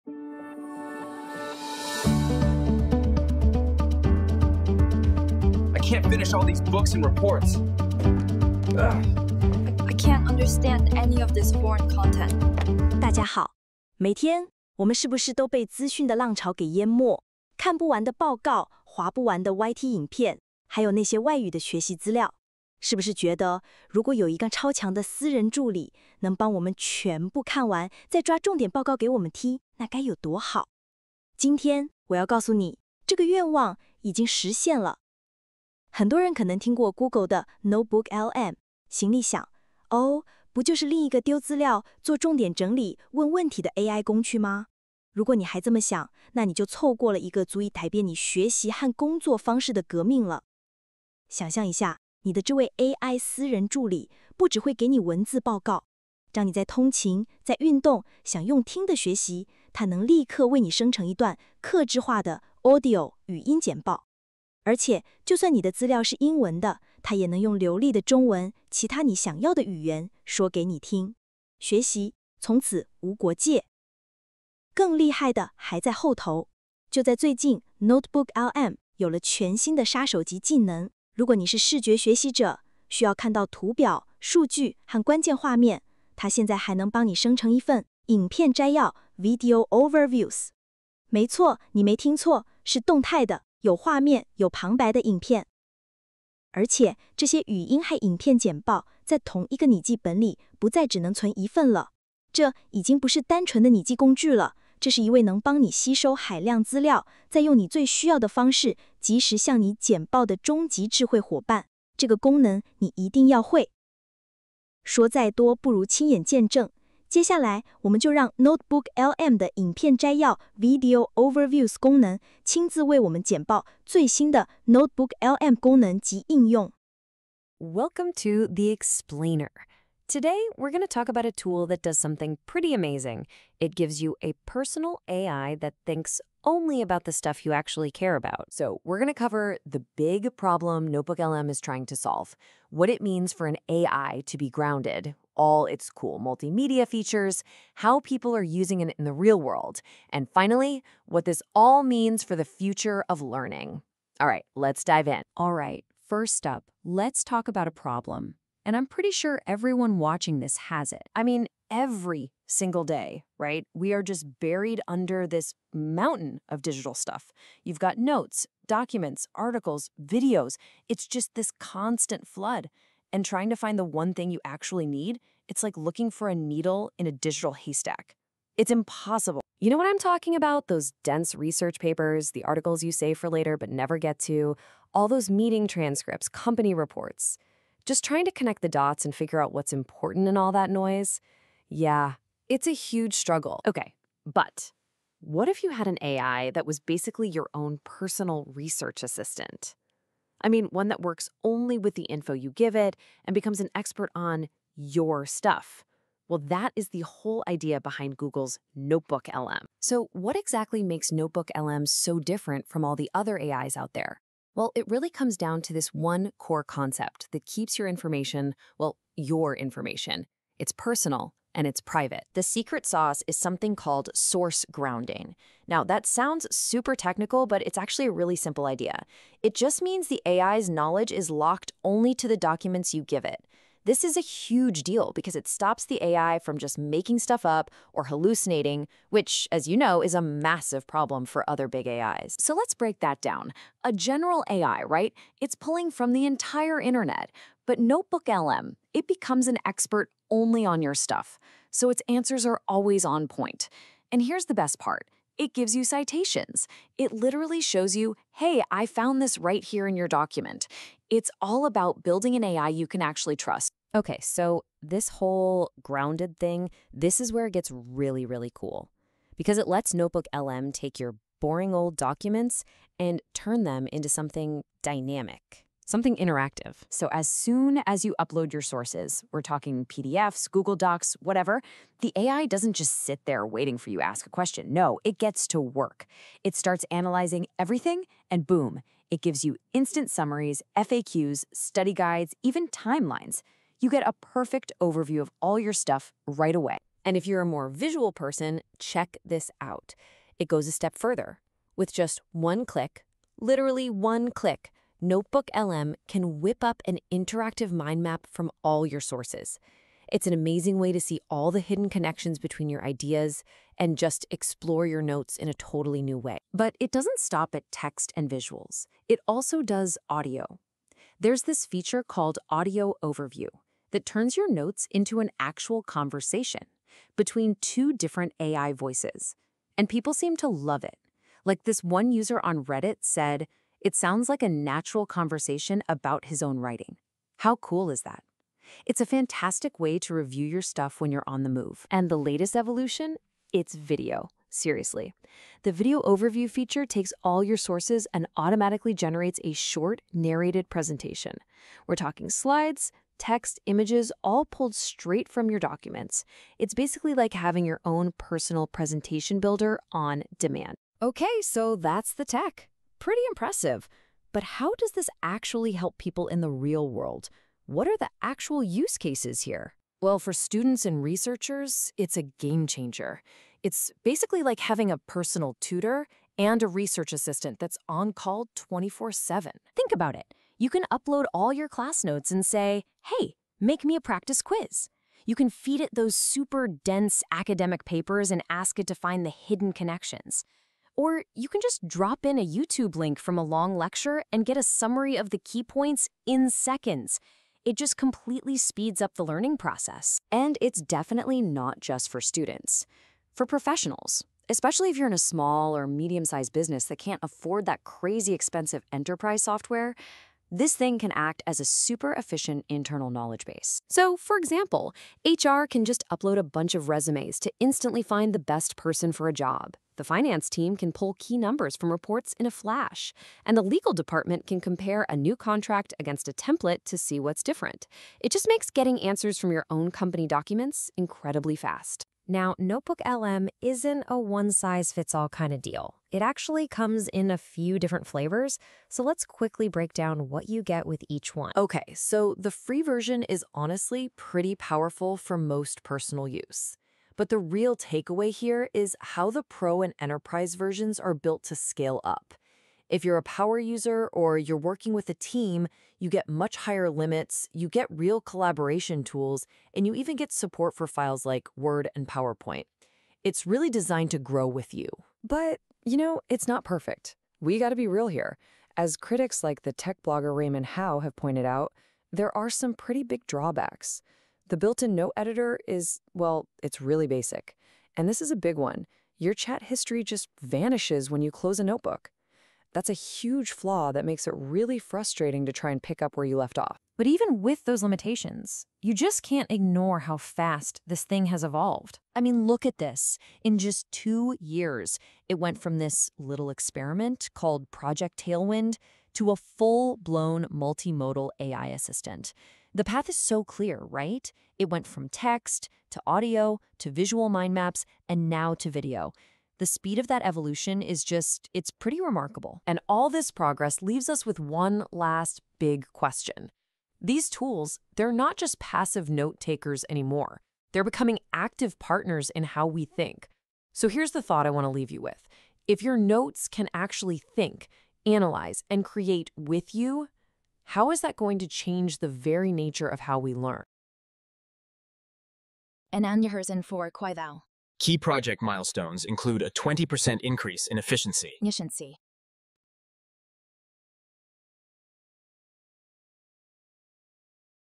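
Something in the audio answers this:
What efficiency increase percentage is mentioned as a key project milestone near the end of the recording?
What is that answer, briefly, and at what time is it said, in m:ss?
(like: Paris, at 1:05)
20%, at 8:59.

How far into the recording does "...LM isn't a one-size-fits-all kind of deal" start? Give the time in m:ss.
7:13.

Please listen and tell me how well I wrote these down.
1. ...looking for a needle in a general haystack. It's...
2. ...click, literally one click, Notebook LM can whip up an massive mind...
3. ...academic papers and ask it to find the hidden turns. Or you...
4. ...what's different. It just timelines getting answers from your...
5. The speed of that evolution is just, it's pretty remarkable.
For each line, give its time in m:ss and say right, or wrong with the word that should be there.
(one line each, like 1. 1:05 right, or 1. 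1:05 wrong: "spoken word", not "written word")
1. 2:55 wrong: "digital", not "general"
2. 5:02 wrong: "interactive", not "massive"
3. 6:27 wrong: "connections", not "turns"
4. 7:07 wrong: "makes", not "timelines"
5. 8:29 right.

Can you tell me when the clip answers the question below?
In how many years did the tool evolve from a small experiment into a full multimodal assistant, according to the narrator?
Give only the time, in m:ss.
8:13.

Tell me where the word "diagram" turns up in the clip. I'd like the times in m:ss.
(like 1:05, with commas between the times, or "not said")
not said.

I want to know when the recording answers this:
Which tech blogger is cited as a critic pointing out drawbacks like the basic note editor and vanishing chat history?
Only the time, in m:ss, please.
7:50.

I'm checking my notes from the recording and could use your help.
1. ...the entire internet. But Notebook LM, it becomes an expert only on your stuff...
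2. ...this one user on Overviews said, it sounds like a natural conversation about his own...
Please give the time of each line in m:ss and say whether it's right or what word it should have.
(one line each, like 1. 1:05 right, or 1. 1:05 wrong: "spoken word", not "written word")
1. 4:06 right
2. 5:31 wrong: "Reddit", not "Overviews".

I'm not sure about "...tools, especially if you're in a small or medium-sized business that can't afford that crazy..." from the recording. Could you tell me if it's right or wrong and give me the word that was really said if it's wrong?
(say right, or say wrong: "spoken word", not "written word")
wrong: "professionals", not "tools".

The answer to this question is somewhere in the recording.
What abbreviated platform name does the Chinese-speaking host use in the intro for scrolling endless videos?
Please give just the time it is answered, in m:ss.
0:19.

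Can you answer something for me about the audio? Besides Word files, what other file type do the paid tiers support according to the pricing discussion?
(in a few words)
PowerPoint.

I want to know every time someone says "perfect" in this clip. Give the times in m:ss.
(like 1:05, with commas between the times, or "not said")
4:54, 7:46.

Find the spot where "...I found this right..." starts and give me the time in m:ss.
4:18.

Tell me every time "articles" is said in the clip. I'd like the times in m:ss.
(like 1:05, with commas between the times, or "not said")
2:49, 3:02.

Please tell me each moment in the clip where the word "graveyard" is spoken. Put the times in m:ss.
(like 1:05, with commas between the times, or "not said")
not said.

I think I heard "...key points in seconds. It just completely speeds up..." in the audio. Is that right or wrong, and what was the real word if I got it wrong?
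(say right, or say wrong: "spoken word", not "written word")
right.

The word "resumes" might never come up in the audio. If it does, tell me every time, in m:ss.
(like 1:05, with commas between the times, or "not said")
6:56.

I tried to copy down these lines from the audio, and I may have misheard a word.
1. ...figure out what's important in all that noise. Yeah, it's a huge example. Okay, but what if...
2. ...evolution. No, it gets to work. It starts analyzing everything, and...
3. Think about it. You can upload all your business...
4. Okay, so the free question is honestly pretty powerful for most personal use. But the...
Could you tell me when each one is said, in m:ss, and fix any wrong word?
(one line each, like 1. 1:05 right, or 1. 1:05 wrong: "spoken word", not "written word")
1. 3:09 wrong: "struggle", not "example"
2. 4:44 wrong: "question", not "evolution"
3. 6:19 wrong: "class", not "business"
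4. 7:21 wrong: "version", not "question".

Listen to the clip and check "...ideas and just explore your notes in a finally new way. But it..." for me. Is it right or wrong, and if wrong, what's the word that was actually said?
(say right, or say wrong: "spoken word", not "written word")
wrong: "totally", not "finally".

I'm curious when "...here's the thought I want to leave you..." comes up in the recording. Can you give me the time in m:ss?
8:43.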